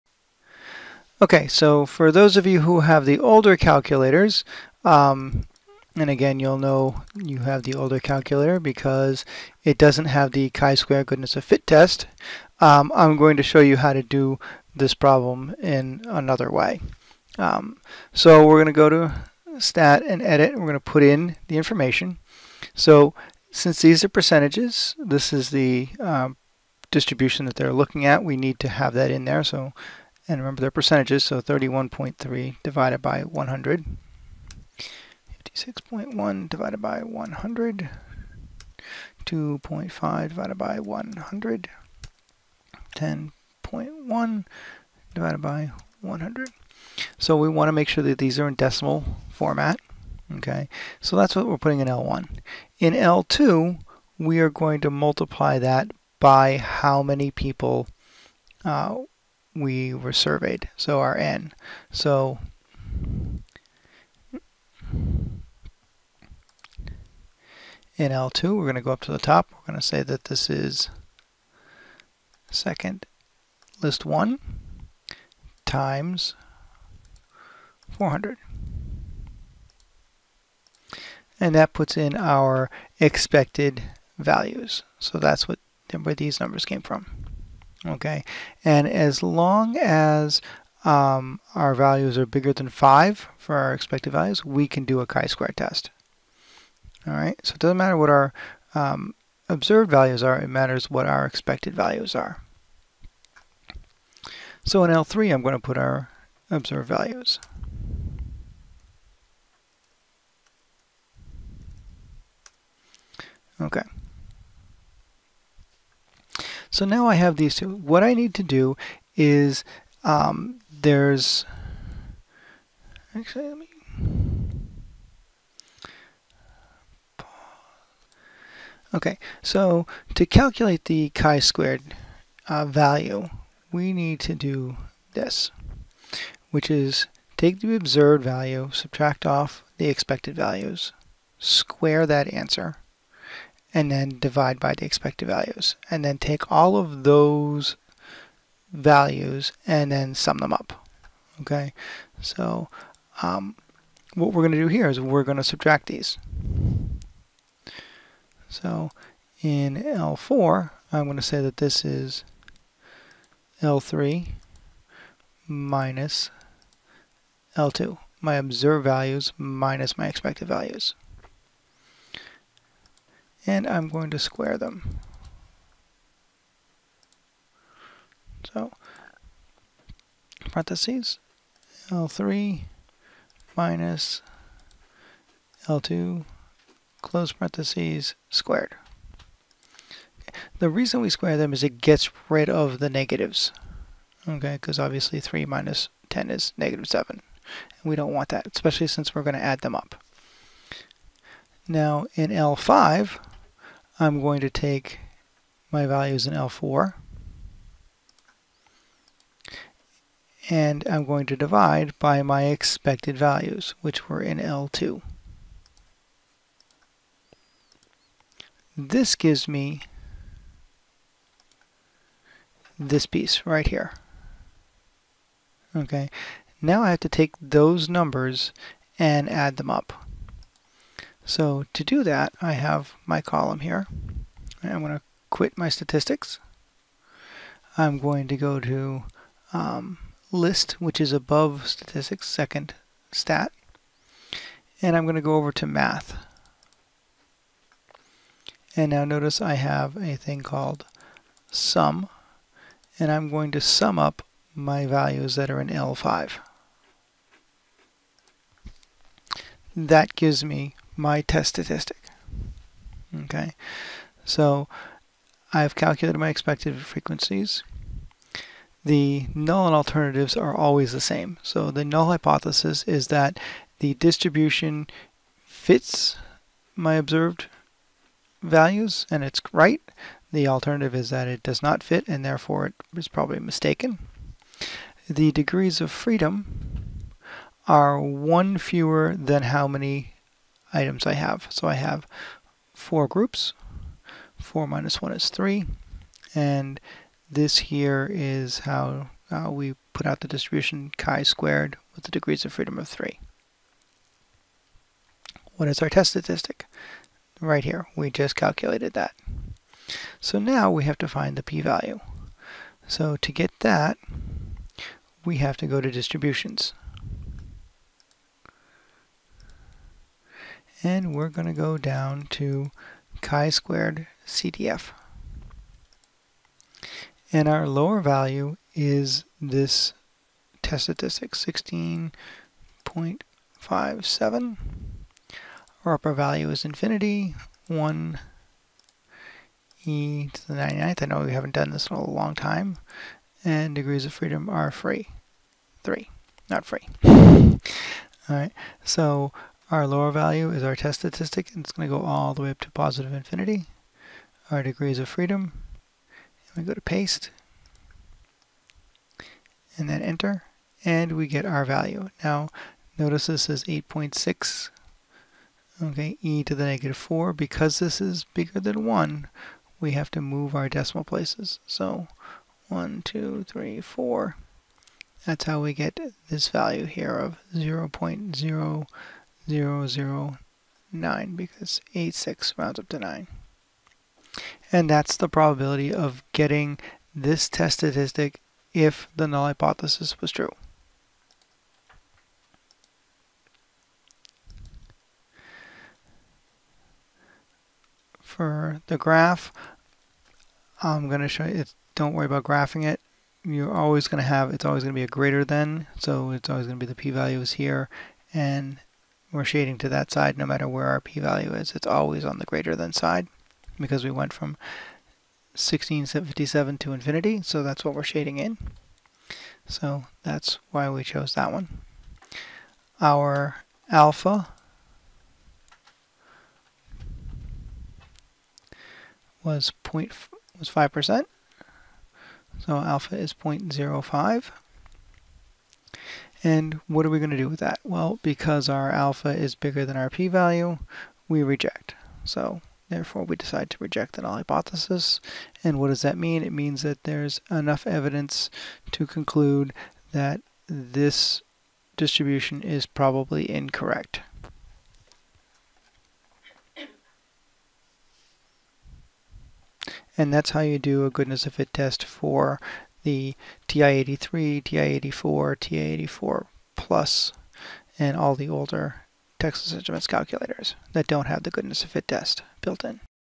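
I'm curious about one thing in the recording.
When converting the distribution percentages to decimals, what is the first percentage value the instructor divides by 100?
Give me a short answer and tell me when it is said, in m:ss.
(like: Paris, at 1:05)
31.3, at 0:31.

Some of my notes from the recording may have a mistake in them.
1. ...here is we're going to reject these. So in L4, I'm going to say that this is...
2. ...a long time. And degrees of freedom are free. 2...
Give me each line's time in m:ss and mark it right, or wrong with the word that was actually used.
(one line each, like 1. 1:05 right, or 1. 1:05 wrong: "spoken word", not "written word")
1. 2:34 wrong: "subtract", not "reject"
2. 5:41 wrong: "3", not "2".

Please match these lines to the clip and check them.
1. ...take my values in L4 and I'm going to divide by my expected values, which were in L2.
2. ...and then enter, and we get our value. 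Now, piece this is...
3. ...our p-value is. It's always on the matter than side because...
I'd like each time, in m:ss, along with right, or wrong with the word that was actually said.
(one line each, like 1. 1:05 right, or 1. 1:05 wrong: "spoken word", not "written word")
1. 3:24 right
2. 5:59 wrong: "notice", not "piece"
3. 6:50 wrong: "greater", not "matter".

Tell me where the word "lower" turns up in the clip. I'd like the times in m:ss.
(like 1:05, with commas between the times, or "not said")
5:27, 5:49.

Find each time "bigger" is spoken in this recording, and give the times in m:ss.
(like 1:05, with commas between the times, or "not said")
1:32, 6:08, 7:19.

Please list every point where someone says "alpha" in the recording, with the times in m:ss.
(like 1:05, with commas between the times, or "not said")
7:03, 7:12, 7:18.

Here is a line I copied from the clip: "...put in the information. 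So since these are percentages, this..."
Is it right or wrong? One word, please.
right.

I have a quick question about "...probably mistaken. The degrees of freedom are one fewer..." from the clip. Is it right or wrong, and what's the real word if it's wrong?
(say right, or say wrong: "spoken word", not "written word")
right.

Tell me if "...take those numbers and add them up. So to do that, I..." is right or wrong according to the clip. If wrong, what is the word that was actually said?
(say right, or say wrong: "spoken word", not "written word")
right.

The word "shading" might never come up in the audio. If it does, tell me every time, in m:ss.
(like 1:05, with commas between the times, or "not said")
6:49, 6:58.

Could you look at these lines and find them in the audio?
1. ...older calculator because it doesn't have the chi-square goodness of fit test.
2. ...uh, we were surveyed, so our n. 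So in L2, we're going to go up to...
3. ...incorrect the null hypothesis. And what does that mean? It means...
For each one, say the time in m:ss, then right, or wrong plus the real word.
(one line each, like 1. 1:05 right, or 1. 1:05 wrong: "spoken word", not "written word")
1. 0:07 right
2. 0:58 right
3. 7:23 wrong: "reject", not "incorrect".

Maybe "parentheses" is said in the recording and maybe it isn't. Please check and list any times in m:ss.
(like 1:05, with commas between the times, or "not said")
3:00, 3:07.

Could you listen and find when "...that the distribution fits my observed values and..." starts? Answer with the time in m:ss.
4:33.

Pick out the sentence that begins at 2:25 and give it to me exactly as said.
And then take all of those values and then sum them up.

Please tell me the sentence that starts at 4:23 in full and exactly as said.
Okay, so I've calculated my expected frequencies.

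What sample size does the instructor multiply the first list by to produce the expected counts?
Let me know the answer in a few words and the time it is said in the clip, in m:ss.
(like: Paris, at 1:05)
400, at 1:17.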